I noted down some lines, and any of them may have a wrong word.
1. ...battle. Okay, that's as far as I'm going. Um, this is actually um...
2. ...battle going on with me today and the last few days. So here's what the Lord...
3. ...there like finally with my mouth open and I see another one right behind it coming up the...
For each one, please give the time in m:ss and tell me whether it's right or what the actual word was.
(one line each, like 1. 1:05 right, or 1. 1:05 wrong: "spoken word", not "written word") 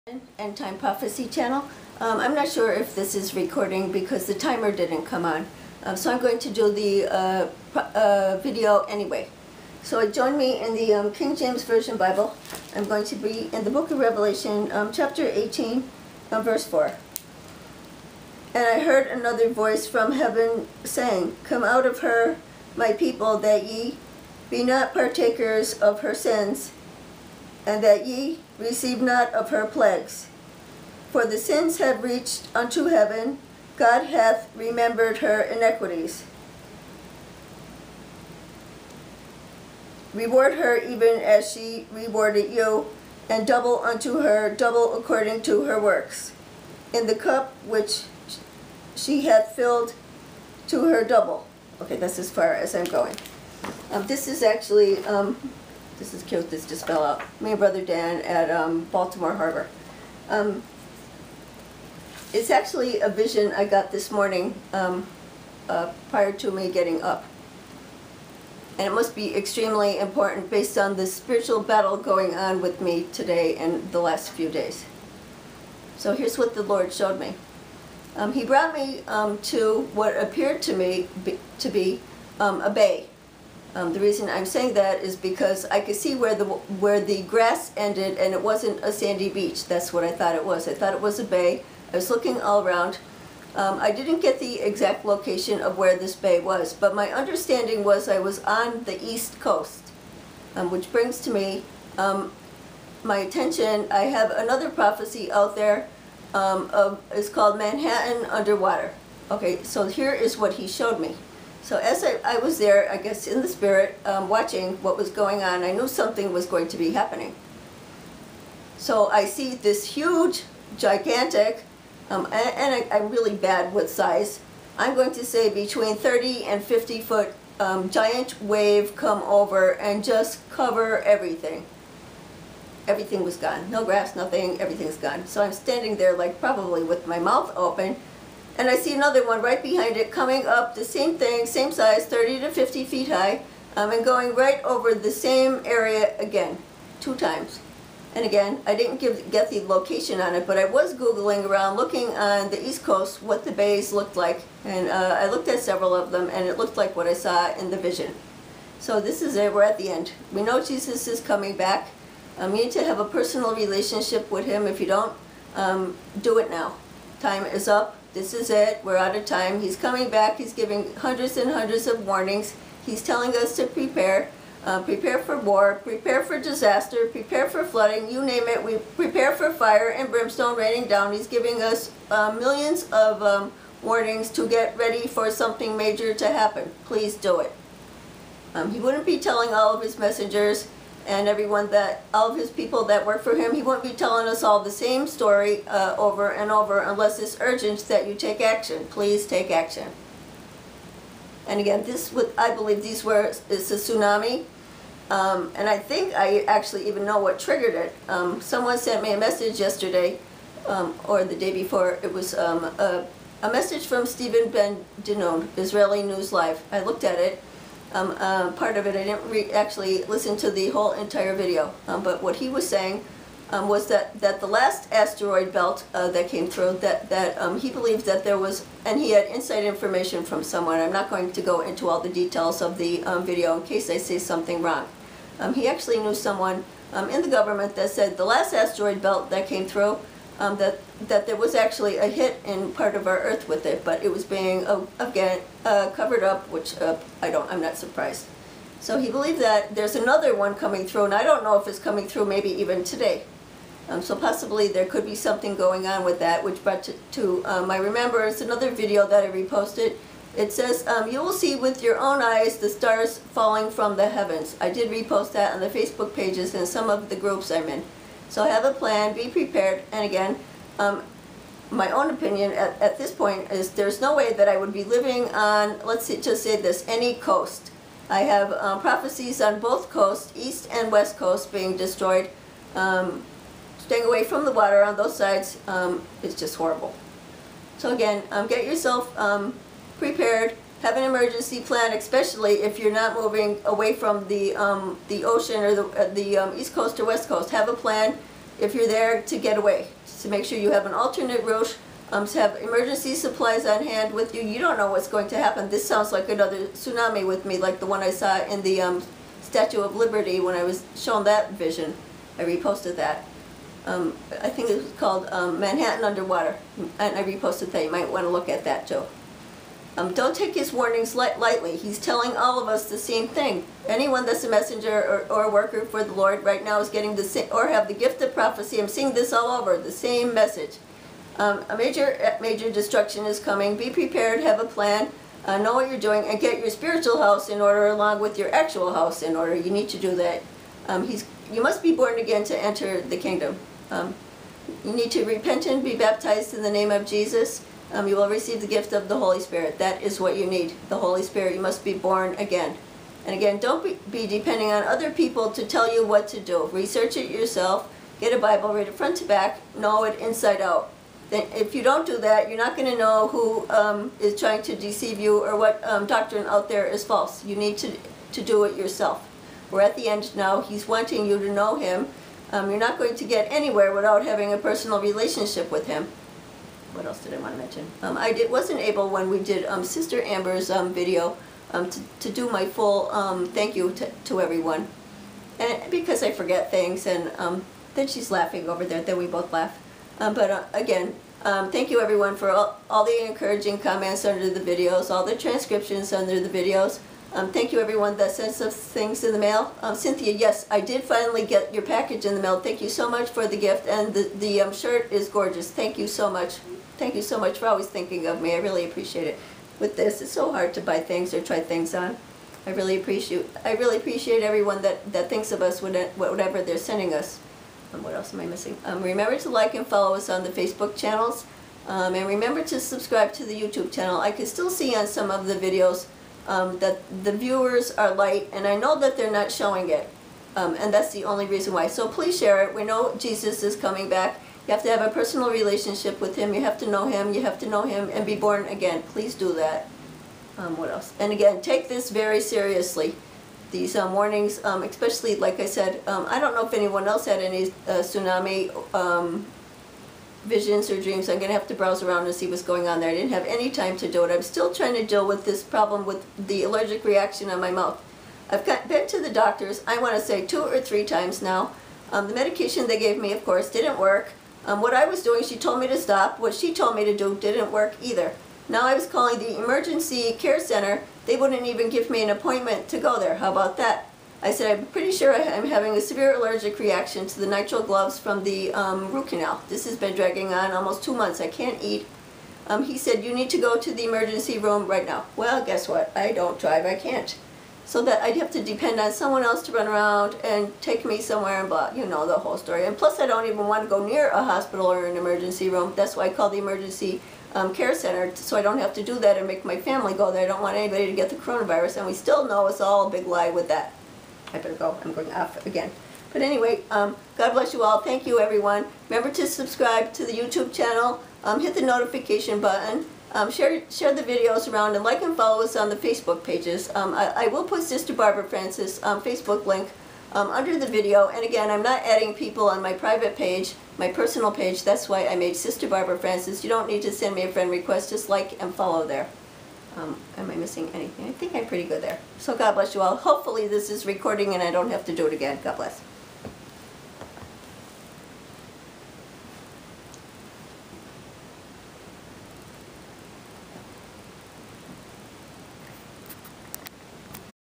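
1. 0:51 wrong: "double", not "battle"
2. 1:11 right
3. 2:15 wrong: "probably", not "finally".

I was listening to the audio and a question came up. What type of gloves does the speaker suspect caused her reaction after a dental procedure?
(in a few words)
Nitrile gloves.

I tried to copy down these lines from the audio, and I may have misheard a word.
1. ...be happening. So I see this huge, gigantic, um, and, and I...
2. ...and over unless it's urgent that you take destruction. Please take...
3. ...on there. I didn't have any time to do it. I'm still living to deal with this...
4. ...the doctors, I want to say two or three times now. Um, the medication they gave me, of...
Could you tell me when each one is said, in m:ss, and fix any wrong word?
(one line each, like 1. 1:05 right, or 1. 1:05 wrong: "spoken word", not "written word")
1. 1:56 right
2. 3:16 wrong: "action", not "destruction"
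3. 7:32 wrong: "trying", not "living"
4. 7:39 right.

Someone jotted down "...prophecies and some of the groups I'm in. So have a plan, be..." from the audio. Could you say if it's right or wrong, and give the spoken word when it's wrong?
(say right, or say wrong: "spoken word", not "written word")
wrong: "pages", not "prophecies".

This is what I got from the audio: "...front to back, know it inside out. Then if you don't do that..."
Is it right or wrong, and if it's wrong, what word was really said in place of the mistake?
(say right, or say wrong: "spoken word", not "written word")
right.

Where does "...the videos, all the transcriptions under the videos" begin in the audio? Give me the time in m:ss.
6:34.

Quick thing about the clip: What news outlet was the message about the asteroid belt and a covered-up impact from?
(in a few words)
Israeli News Live.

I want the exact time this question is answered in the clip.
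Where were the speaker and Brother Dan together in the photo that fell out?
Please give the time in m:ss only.
0:58.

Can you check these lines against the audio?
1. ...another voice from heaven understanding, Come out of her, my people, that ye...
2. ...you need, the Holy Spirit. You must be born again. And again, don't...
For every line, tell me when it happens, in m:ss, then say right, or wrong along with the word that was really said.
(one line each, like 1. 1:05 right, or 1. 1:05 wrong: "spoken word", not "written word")
1. 0:19 wrong: "saying", not "understanding"
2. 5:50 right.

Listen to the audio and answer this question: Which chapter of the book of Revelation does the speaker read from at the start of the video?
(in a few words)
18.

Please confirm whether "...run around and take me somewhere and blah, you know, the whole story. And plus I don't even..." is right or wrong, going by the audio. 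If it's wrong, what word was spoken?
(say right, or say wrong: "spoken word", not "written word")
right.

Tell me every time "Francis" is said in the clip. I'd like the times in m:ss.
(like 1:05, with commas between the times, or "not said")
8:38, 8:46.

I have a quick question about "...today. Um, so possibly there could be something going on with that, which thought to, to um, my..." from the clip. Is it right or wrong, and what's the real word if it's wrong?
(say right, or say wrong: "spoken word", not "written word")
wrong: "brought", not "thought".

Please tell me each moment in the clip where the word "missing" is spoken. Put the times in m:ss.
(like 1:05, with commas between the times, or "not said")
6:58, 8:50.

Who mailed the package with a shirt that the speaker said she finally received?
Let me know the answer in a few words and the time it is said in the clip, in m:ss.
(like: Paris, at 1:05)
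Cynthia, at 6:39.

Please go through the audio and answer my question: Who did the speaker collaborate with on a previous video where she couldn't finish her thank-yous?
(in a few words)
Sister Amber.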